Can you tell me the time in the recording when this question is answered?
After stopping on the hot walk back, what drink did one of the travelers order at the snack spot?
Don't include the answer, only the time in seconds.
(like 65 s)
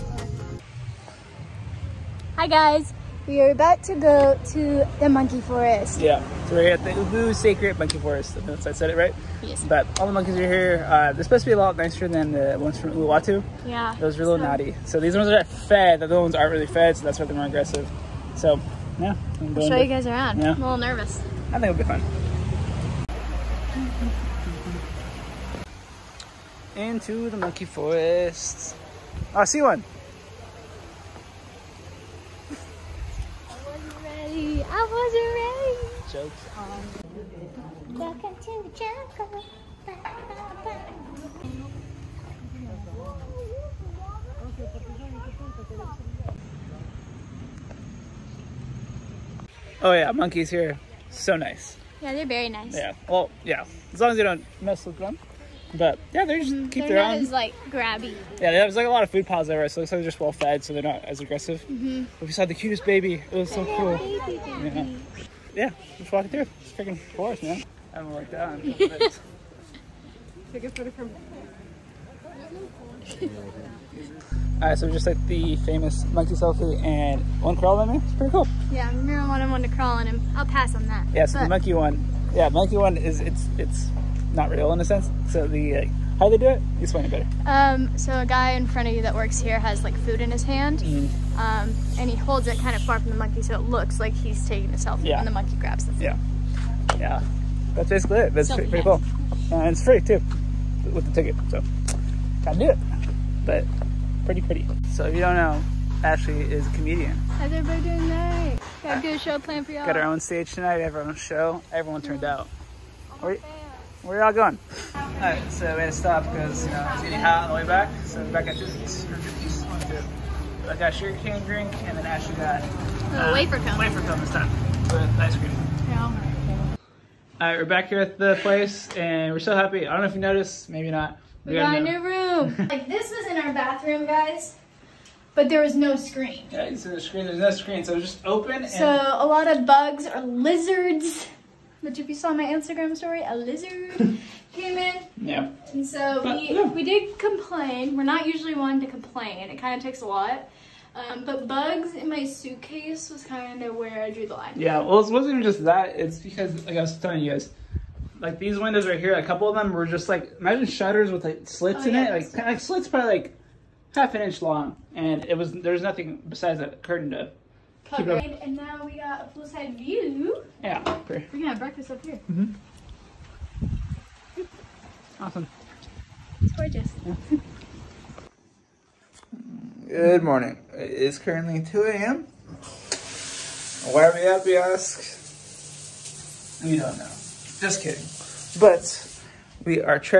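120 s.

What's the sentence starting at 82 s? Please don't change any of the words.
Yeah, monkey one is it's it's not real in a sense.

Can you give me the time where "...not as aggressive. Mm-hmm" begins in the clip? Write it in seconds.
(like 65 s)
60 s.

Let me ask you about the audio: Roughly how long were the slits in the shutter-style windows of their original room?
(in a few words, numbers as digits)
half an inch.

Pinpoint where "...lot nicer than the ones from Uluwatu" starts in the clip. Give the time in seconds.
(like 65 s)
11 s.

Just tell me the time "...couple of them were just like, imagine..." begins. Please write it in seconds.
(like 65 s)
159 s.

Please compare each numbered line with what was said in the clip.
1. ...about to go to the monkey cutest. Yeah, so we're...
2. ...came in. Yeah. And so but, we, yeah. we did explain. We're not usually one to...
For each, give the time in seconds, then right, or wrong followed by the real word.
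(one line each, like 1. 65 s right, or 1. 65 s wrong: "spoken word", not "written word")
1. 3 s wrong: "forest", not "cutest"
2. 144 s wrong: "complain", not "explain".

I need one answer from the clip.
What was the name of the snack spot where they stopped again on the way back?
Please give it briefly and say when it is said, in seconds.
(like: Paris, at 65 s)
Tootsies, at 118 s.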